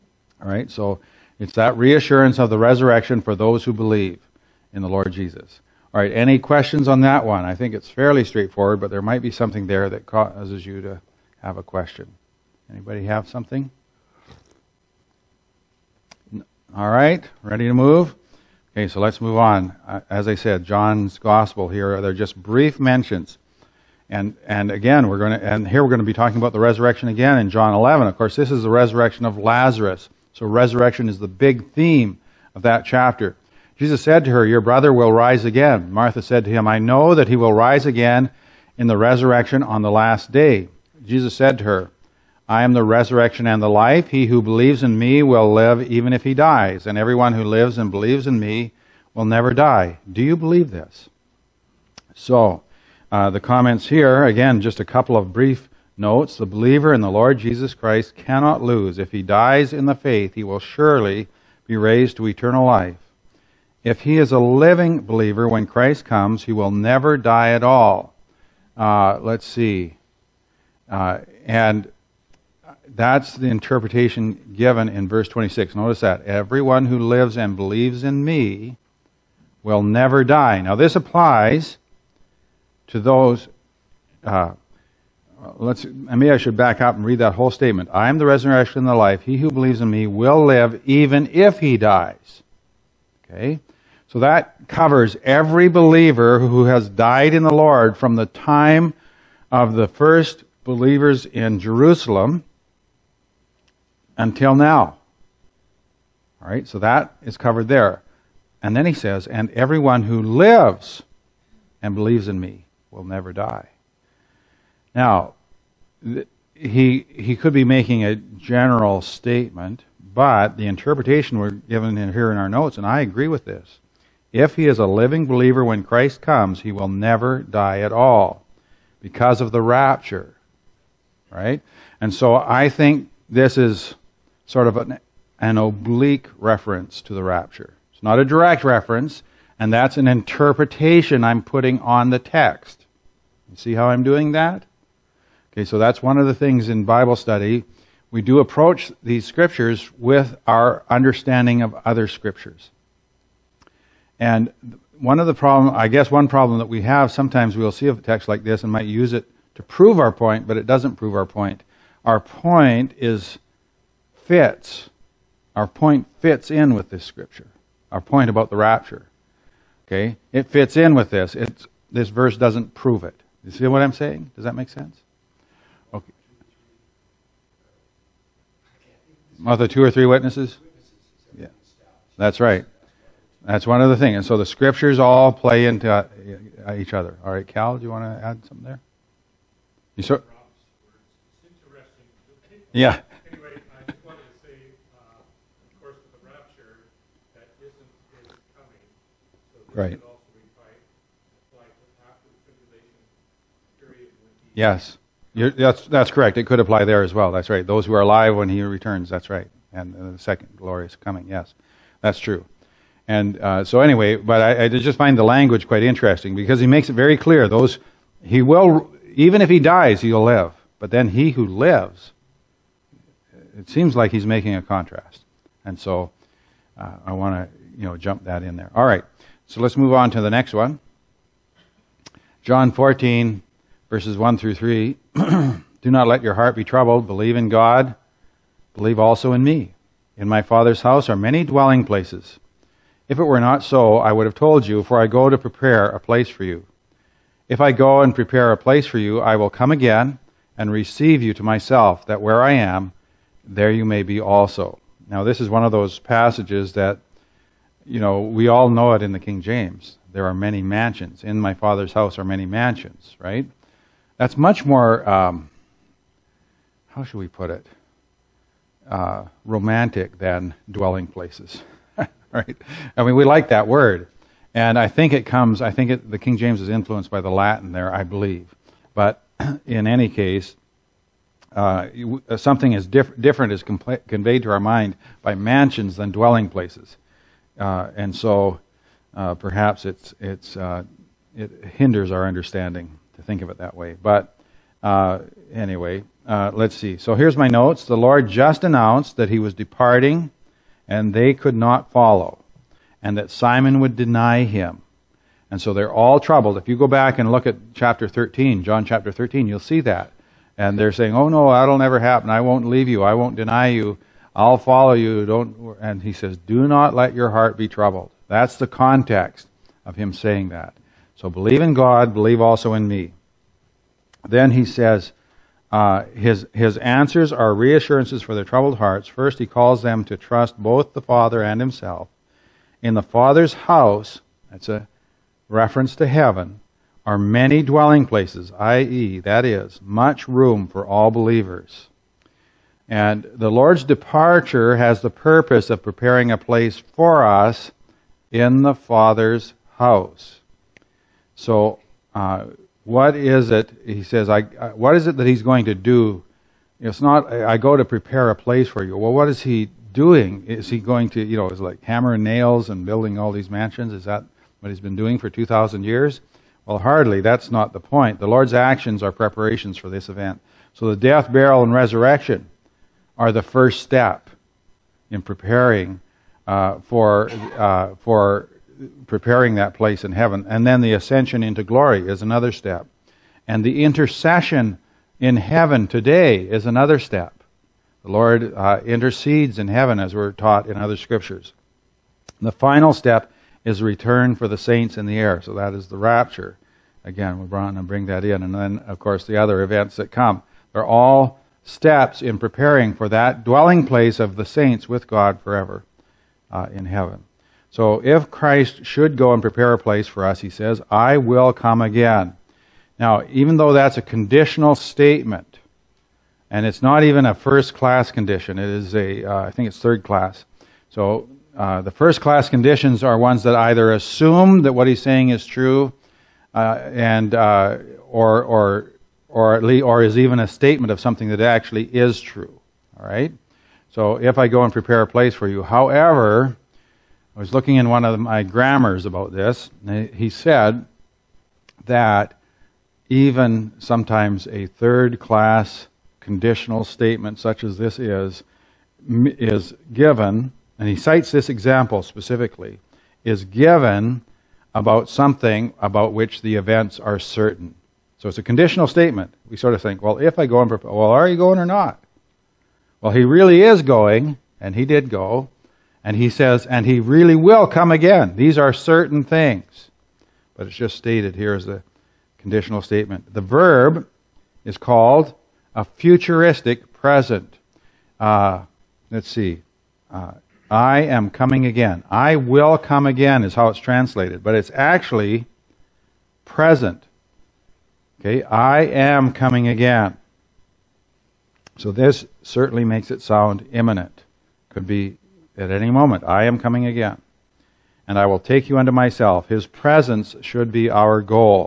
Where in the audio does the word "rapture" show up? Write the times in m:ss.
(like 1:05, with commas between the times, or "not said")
2:09, 2:17, 2:48, 6:35.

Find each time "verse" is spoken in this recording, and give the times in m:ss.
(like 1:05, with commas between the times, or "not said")
1:15, 2:52, 3:53.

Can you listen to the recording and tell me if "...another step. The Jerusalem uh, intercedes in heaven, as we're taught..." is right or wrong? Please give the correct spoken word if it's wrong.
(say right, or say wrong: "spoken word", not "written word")
wrong: "Lord", not "Jerusalem".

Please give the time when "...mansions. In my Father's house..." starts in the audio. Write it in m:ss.
4:20.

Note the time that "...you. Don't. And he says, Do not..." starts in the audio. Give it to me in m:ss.
5:14.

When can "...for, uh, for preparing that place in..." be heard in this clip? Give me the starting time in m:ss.
6:16.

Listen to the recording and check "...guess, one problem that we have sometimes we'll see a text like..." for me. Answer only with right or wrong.
right.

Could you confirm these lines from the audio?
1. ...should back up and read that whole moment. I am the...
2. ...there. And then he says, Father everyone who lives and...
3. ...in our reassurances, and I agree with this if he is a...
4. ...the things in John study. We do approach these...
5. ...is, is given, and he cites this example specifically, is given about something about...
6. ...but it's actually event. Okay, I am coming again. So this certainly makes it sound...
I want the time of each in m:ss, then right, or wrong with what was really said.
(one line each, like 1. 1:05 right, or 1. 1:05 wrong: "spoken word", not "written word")
1. 1:26 wrong: "statement", not "moment"
2. 1:47 wrong: "And", not "Father"
3. 2:02 wrong: "notes", not "reassurances"
4. 2:26 wrong: "Bible", not "John"
5. 7:27 right
6. 8:04 wrong: "present", not "event".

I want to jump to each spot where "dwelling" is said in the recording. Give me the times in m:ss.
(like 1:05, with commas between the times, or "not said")
4:01, 4:30, 4:46, 5:37, 6:43.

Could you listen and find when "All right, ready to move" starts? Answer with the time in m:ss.
0:16.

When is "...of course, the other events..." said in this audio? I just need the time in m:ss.
6:38.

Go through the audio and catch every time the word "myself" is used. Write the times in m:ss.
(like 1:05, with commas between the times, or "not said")
4:11, 8:18.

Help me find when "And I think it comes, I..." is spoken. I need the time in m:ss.
4:34.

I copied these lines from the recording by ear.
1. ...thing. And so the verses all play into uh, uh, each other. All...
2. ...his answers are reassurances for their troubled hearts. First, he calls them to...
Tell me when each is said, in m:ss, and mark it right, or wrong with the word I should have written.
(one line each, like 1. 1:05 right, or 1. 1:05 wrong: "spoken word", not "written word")
1. 3:03 wrong: "scriptures", not "verses"
2. 5:26 right.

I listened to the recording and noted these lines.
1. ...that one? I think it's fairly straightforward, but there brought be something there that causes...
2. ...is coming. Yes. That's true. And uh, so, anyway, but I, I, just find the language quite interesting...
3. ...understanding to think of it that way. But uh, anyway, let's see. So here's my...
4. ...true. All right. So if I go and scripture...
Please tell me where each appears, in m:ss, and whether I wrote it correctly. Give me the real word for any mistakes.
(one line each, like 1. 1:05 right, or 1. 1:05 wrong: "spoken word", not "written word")
1. 0:07 wrong: "might", not "brought"
2. 3:30 right
3. 4:52 right
4. 7:12 wrong: "prepare", not "scripture".